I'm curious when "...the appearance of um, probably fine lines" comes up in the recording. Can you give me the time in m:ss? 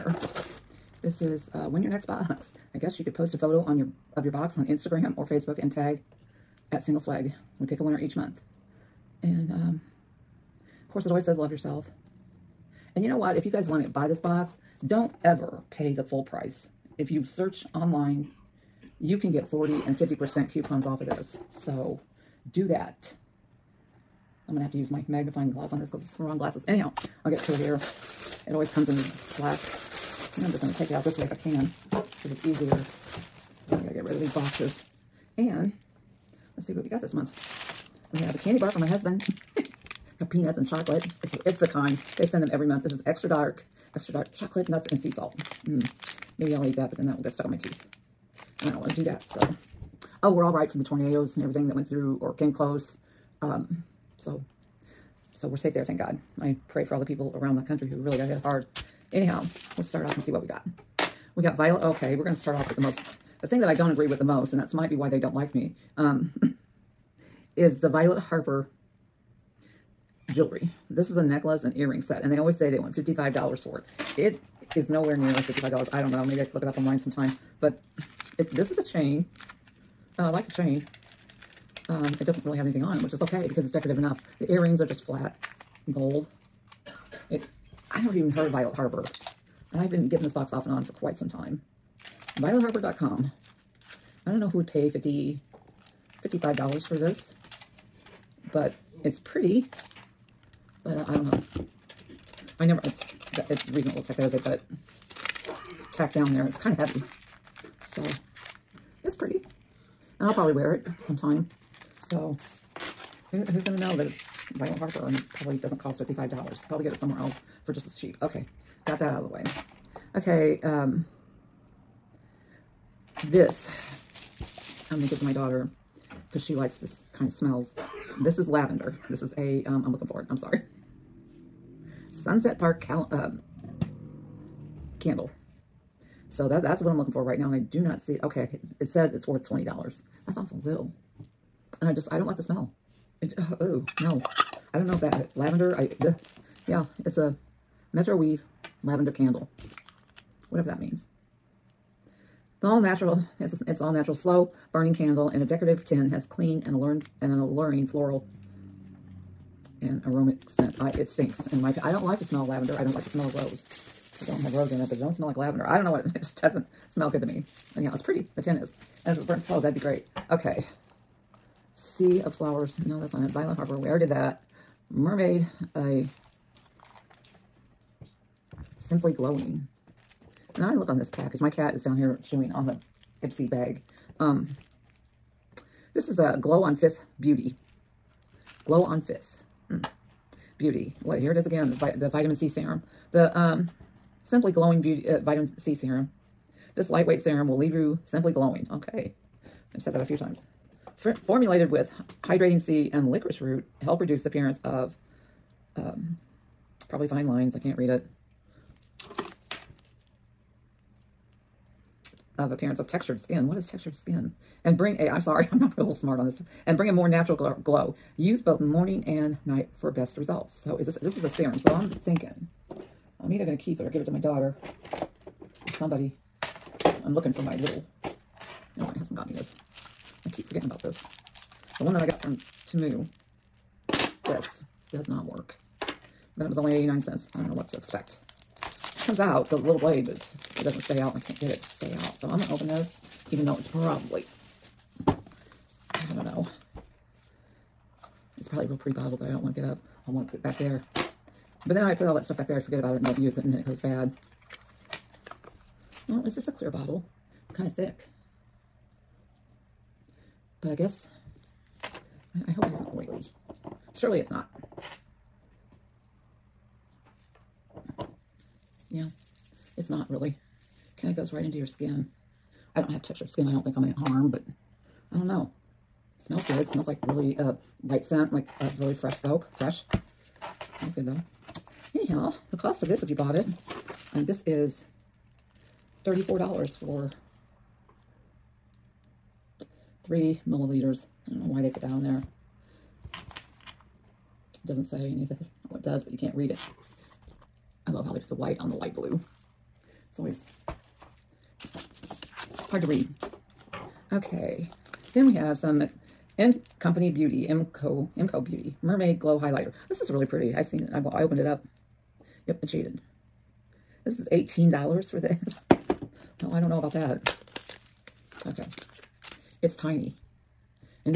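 3:24.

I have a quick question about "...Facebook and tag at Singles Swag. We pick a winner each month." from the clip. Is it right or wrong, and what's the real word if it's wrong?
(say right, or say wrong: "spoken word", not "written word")
right.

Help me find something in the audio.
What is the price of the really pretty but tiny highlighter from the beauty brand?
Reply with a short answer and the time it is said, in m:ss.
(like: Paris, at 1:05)
$18, at 5:14.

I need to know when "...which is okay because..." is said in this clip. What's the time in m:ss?
1:23.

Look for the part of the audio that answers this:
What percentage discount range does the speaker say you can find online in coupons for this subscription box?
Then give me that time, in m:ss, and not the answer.
0:19.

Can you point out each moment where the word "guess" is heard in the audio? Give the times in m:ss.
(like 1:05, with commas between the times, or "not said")
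0:02, 4:20.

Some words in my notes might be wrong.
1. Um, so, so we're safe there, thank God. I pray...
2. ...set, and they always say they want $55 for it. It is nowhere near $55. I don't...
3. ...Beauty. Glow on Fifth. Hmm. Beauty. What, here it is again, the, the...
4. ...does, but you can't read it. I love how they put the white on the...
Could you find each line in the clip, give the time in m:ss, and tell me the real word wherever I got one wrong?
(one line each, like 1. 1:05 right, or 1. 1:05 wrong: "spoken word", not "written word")
1. 0:53 right
2. 1:12 right
3. 3:07 right
4. 4:55 right.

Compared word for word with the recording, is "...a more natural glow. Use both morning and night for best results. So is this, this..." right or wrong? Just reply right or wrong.
right.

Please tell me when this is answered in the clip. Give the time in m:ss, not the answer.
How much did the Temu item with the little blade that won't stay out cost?
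3:56.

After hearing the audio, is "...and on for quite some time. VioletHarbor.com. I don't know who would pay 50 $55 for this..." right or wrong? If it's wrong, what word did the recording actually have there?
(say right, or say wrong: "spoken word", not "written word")
right.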